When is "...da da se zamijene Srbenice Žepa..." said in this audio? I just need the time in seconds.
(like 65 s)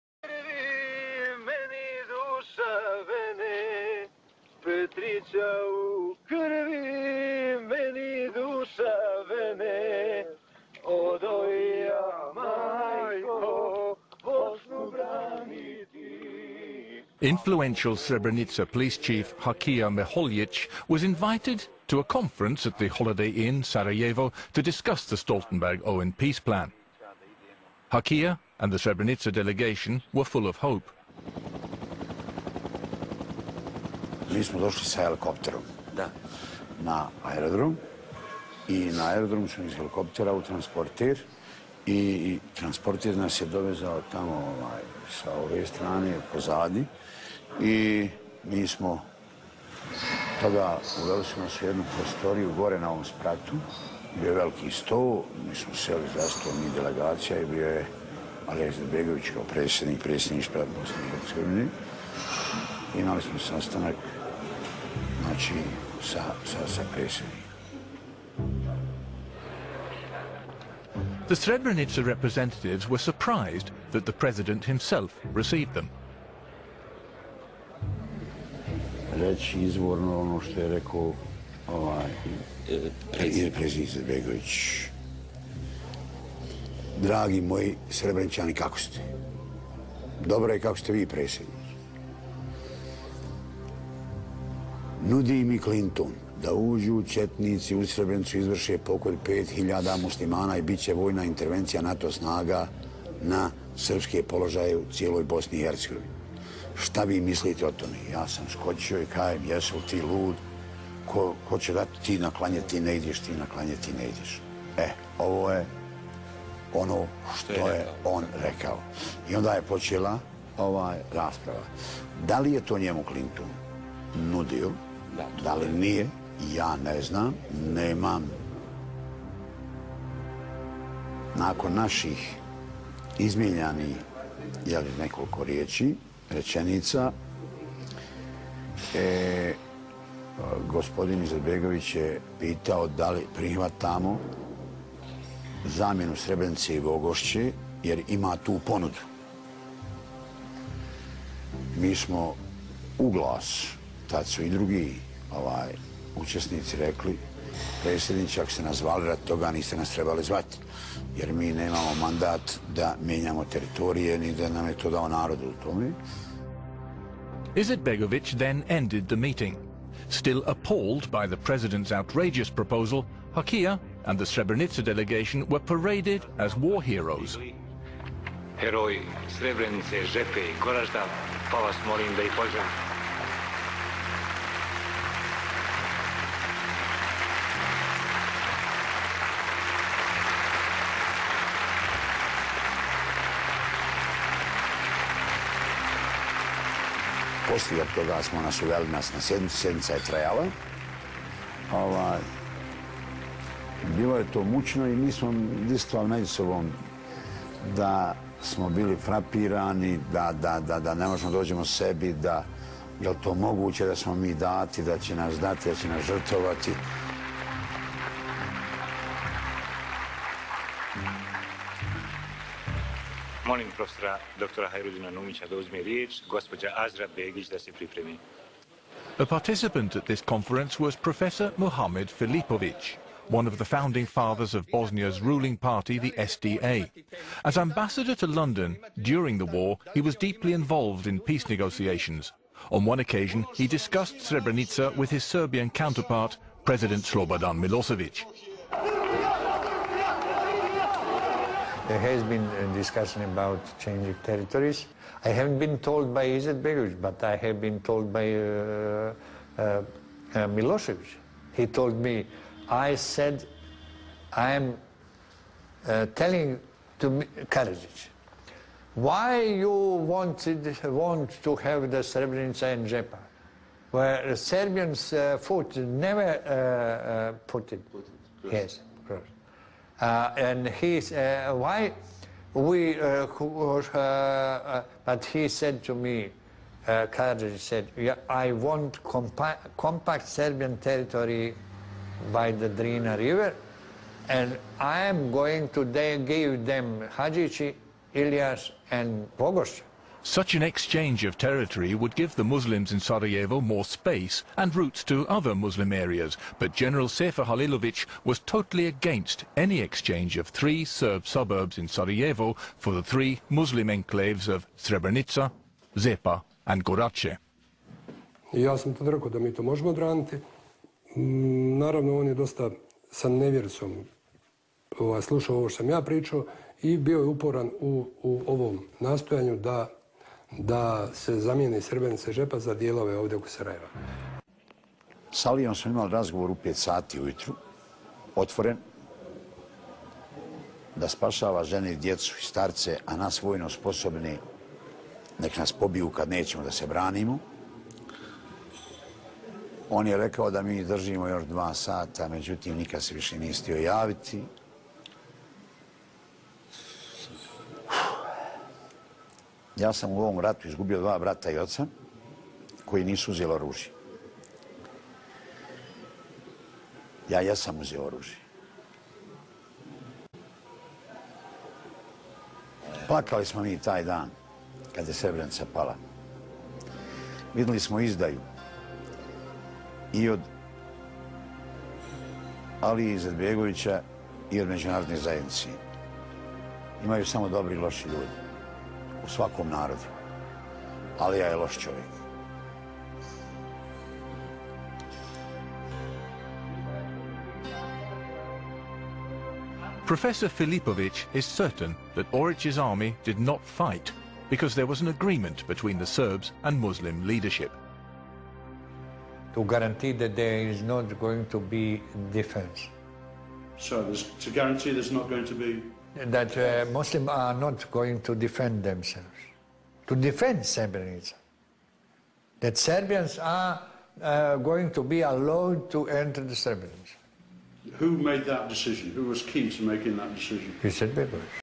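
329 s.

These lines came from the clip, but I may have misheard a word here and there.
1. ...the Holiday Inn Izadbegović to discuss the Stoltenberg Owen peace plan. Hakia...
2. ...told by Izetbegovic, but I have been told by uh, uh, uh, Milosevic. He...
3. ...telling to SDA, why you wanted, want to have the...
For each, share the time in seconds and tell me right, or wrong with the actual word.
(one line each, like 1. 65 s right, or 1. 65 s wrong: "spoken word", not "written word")
1. 22 s wrong: "Sarajevo", not "Izadbegović"
2. 255 s right
3. 266 s wrong: "Karadzic", not "SDA".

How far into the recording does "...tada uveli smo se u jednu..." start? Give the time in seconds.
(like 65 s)
50 s.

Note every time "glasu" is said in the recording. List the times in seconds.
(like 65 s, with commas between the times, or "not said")
153 s.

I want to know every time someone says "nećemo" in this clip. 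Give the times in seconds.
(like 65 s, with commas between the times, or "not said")
346 s.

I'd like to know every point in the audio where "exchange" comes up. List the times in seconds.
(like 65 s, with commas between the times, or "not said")
300 s, 309 s.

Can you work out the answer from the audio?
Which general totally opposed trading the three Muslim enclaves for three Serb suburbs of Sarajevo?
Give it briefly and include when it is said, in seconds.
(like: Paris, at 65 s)
Sefer Halilovic, at 307 s.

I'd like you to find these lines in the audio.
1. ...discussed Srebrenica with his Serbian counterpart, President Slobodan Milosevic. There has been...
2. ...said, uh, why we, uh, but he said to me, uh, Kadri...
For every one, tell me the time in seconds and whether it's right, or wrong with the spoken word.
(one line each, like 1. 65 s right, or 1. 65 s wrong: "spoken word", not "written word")
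1. 243 s right
2. 280 s right.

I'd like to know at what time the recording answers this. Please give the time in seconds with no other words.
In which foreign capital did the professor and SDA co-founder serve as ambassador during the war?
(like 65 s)
238 s.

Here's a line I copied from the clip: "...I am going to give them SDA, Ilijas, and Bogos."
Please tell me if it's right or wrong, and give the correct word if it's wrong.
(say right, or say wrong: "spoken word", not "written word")
wrong: "Hadzici", not "SDA".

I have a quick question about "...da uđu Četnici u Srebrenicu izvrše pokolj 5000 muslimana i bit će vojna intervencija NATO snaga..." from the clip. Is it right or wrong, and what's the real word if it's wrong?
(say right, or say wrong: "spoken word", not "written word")
right.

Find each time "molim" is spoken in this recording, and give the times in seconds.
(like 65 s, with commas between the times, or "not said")
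181 s, 223 s.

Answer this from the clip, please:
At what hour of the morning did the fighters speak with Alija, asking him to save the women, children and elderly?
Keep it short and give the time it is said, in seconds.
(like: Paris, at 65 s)
5 a.m., at 336 s.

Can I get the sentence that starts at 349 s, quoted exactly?
On je rekao da mi držimo još dva sata, međutim nikad se više nije stio javiti.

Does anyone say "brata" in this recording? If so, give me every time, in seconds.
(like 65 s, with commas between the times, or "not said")
361 s.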